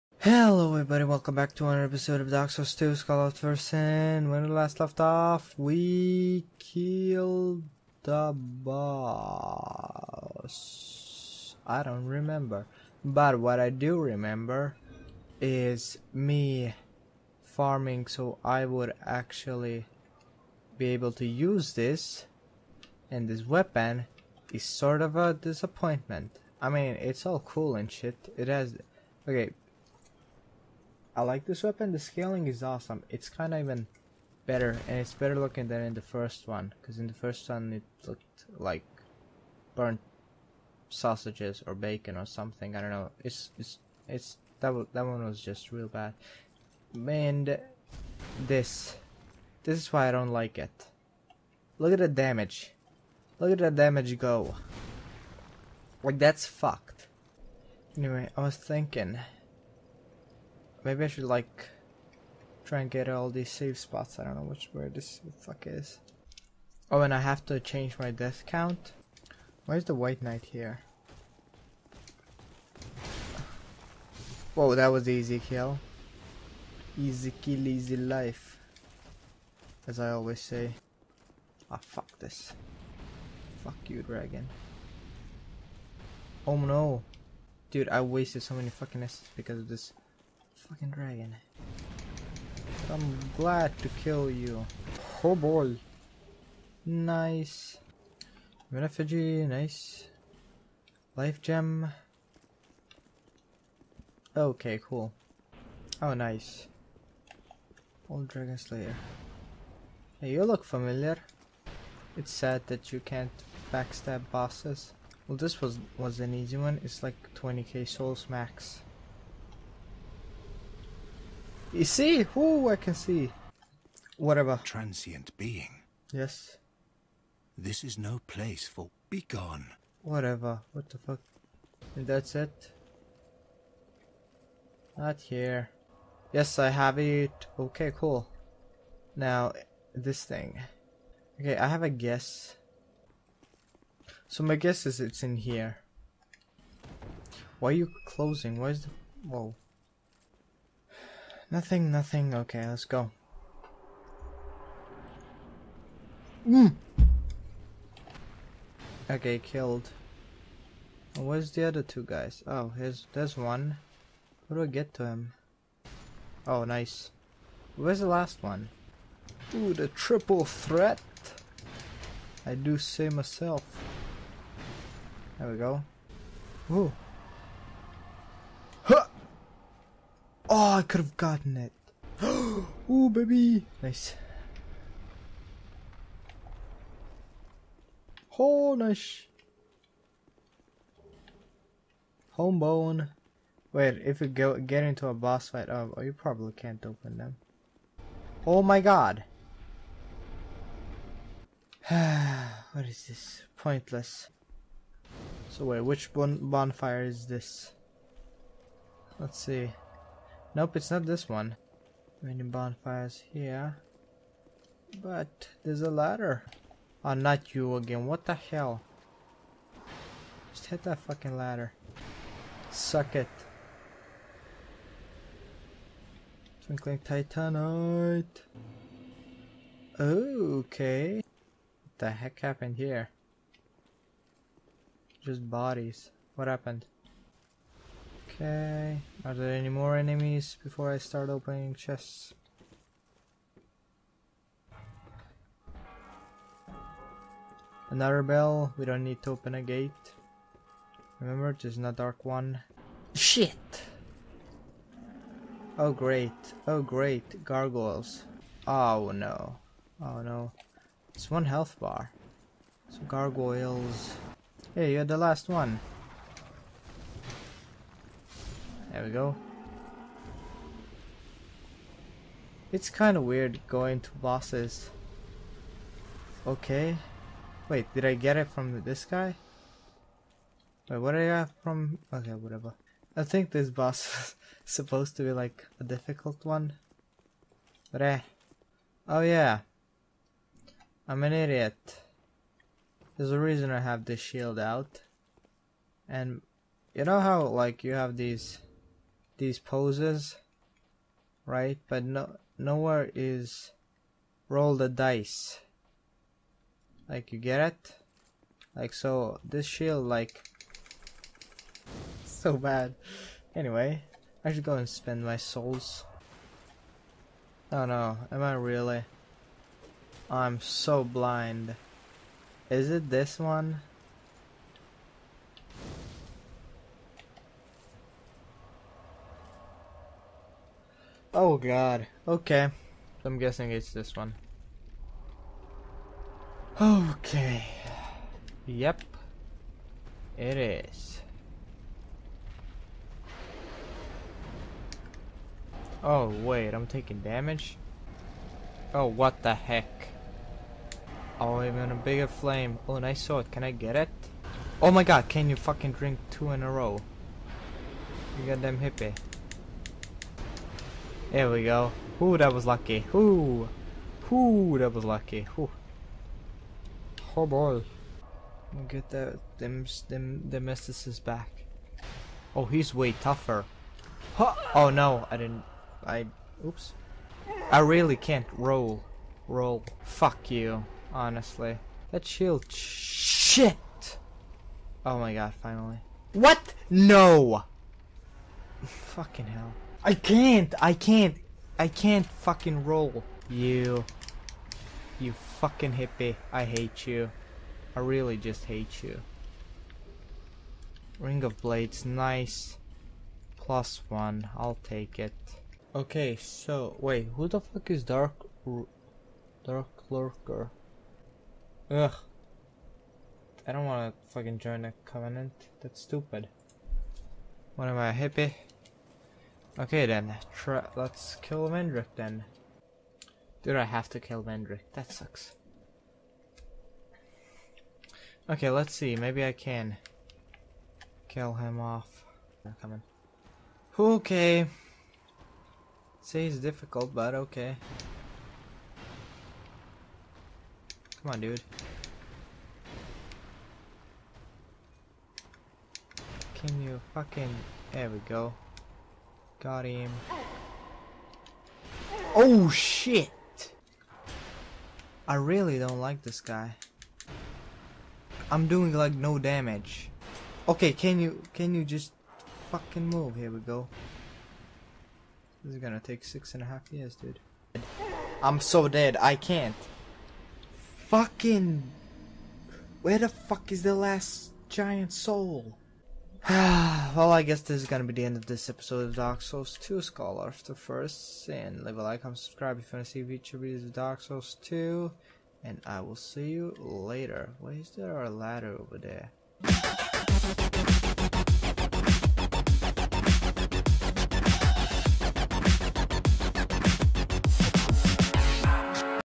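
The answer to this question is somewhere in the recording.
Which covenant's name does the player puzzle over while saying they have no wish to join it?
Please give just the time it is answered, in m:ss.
6:49.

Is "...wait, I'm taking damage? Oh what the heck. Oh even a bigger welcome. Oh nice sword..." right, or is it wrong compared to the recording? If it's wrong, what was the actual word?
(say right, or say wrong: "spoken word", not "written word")
wrong: "flame", not "welcome".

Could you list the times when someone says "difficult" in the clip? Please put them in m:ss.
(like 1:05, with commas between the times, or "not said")
4:45, 7:16.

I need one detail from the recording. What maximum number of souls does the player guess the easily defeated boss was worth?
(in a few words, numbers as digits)
20k.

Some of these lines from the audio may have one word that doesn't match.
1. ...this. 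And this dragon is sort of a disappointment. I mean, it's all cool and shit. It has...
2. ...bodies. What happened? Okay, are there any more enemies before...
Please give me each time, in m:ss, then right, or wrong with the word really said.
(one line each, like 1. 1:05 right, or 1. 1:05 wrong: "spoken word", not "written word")
1. 0:21 wrong: "weapon", not "dragon"
2. 3:55 right.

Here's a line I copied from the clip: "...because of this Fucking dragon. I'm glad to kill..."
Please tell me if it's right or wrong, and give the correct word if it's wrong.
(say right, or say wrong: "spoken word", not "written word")
right.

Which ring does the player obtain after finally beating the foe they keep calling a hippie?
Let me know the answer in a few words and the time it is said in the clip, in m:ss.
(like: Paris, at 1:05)
Ring of Blades, at 6:41.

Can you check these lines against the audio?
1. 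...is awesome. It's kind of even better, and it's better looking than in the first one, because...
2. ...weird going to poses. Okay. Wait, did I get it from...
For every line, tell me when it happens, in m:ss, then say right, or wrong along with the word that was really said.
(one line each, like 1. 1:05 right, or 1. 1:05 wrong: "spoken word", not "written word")
1. 0:32 right
2. 4:33 wrong: "bosses", not "poses".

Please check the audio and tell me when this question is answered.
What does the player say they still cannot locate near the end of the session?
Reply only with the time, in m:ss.
7:53.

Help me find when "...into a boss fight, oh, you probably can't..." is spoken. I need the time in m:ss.
3:14.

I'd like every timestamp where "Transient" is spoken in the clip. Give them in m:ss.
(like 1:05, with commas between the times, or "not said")
2:04.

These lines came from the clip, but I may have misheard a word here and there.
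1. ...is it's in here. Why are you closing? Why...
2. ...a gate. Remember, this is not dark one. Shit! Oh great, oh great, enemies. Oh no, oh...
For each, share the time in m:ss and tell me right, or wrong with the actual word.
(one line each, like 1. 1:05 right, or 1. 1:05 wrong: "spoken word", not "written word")
1. 2:24 right
2. 4:09 wrong: "gargoyles", not "enemies".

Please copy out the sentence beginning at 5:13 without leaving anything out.
Anyway, I should go and spend my souls.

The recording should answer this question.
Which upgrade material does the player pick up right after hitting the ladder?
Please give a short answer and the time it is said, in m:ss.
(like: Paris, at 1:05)
Twinkling Titanite, at 3:46.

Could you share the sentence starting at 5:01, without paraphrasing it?
But no, nowhere is roll the dice.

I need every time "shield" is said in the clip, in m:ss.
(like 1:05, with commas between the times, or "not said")
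4:54, 5:09, 6:22.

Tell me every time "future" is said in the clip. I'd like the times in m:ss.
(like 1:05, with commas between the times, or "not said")
8:03.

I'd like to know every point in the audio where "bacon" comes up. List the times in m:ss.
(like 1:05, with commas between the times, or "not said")
0:41.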